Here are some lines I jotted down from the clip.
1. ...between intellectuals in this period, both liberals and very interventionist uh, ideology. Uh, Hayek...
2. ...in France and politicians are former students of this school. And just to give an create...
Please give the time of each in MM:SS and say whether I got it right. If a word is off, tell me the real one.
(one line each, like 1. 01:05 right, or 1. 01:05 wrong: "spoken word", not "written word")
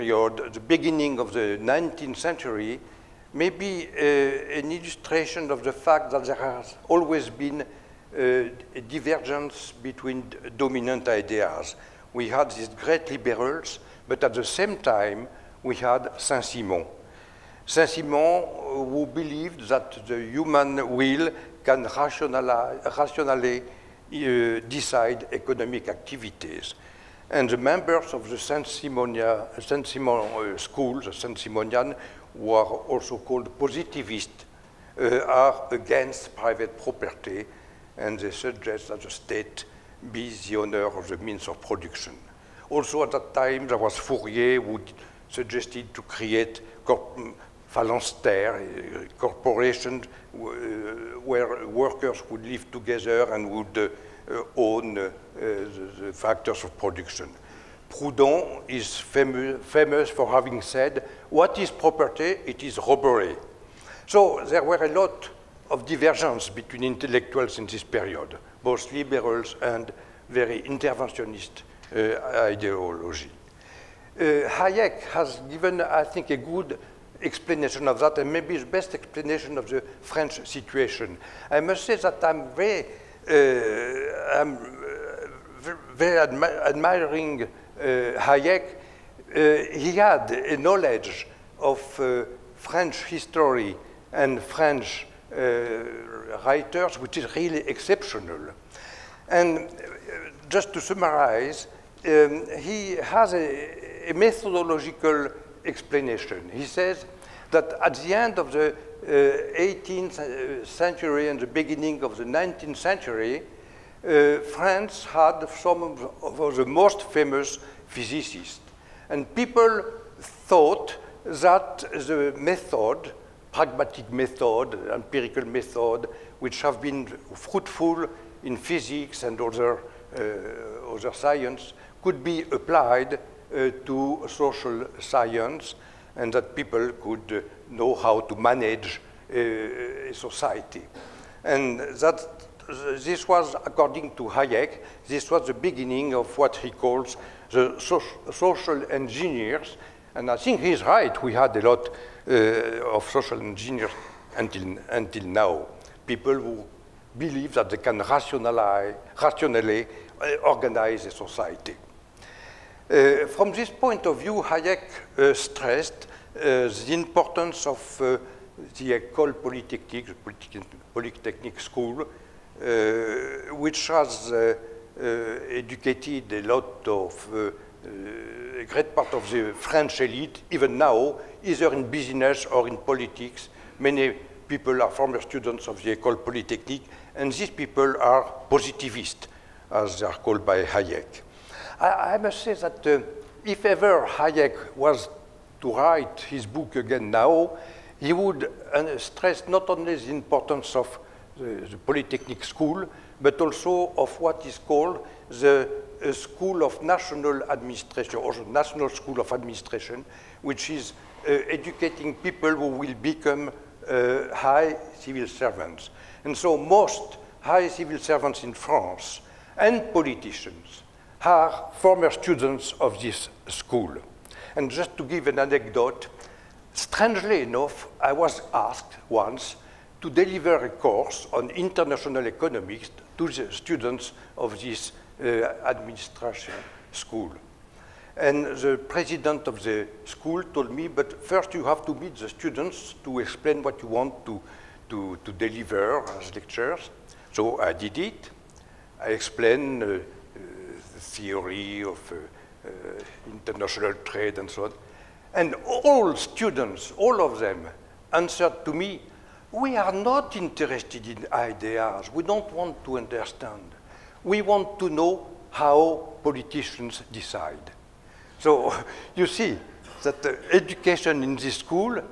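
1. 01:06 right
2. 03:38 wrong: "anecdote", not "create".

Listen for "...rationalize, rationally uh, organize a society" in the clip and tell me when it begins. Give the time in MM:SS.
02:37.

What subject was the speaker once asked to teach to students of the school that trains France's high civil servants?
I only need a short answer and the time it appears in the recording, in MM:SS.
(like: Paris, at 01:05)
international economics, at 03:51.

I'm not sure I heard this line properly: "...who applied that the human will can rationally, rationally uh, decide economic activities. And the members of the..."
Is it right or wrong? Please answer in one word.
wrong.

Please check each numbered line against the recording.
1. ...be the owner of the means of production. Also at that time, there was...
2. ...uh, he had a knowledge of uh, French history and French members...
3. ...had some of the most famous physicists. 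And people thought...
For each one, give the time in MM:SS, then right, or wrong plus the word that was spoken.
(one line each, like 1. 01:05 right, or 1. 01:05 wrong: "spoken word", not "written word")
1. 00:40 right
2. 01:29 wrong: "writers", not "members"
3. 01:55 right.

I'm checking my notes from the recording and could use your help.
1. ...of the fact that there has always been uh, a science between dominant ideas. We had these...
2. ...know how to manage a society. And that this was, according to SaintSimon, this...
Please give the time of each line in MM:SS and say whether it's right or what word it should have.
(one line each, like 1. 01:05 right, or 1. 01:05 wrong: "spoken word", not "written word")
1. 00:05 wrong: "divergence", not "science"
2. 02:17 wrong: "Hayek", not "SaintSimon".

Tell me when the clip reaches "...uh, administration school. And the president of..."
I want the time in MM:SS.
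03:55.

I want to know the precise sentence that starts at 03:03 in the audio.
Many people are former students of the École Polytechnique, and these people are positivist, as they are called by Hayek.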